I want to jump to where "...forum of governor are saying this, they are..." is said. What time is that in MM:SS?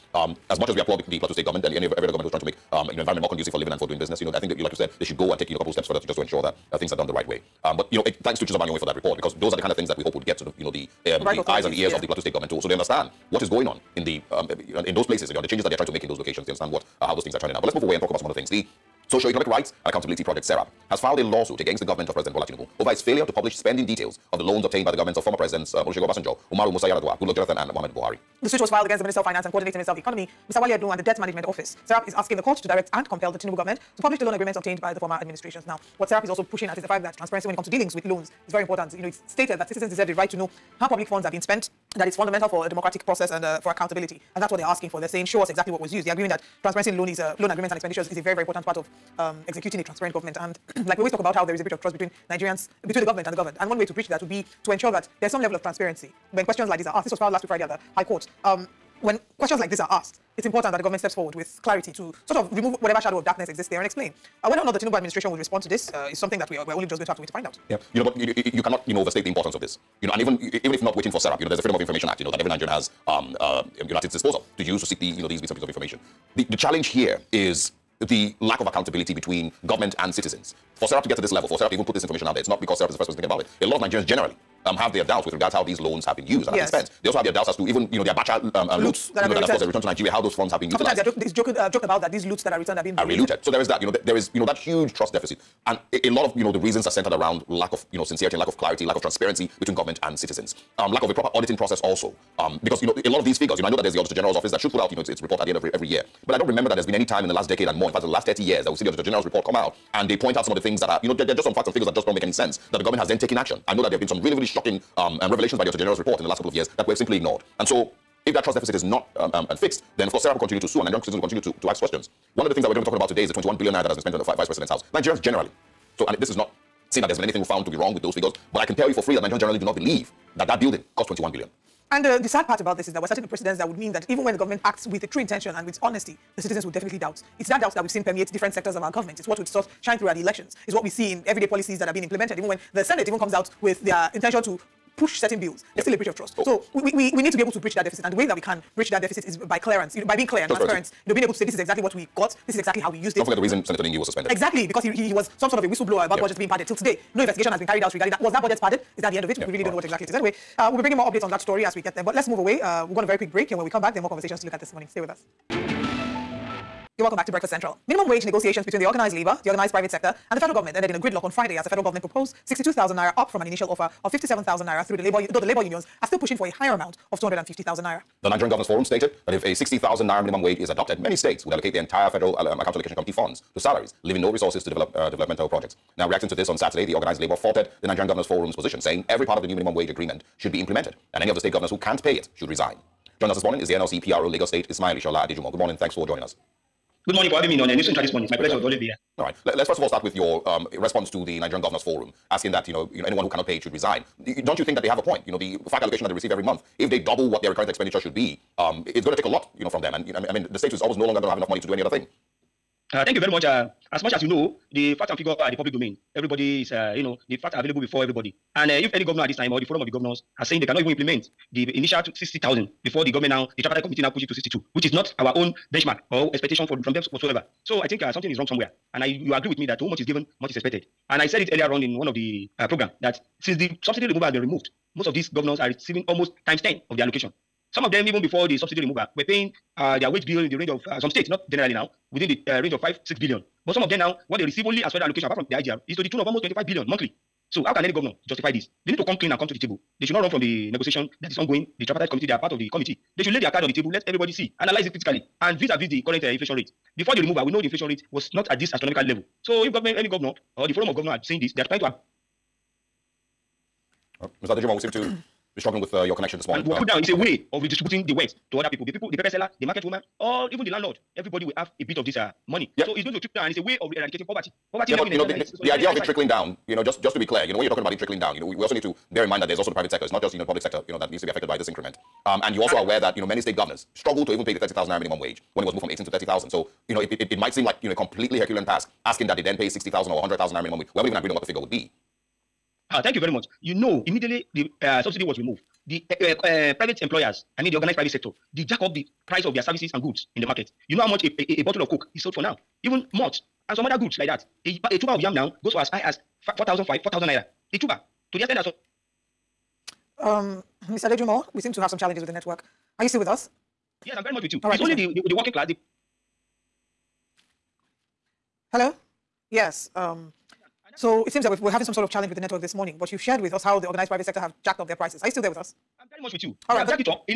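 04:20.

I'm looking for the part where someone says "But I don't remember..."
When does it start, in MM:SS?
01:46.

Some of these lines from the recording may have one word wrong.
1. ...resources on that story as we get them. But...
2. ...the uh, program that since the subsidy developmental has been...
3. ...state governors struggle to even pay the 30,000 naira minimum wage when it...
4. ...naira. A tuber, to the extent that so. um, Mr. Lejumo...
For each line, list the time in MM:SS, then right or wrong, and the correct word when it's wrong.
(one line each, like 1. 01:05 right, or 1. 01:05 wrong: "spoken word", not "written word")
1. 02:41 wrong: "updates", not "resources"
2. 03:52 wrong: "removal", not "developmental"
3. 04:43 right
4. 05:07 right.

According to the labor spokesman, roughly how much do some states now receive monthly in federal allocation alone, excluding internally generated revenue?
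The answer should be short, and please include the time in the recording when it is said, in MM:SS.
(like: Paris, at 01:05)
25 billion, at 04:06.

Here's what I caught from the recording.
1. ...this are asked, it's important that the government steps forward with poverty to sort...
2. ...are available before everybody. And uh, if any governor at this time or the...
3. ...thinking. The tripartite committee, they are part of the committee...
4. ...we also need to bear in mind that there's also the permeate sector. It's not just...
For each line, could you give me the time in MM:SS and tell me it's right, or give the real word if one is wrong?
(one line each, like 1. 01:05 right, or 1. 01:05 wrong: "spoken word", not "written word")
1. 00:59 wrong: "clarity", not "poverty"
2. 03:37 right
3. 04:11 wrong: "ongoing", not "thinking"
4. 04:38 wrong: "private", not "permeate".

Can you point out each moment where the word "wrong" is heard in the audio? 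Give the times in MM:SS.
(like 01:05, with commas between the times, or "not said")
02:07, 03:48.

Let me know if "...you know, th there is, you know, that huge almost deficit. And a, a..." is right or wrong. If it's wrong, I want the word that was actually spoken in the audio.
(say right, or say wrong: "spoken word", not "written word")
wrong: "trust", not "almost".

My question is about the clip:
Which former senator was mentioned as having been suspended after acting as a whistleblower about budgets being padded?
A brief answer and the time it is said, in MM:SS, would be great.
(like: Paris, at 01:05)
Senator Ningi, at 02:33.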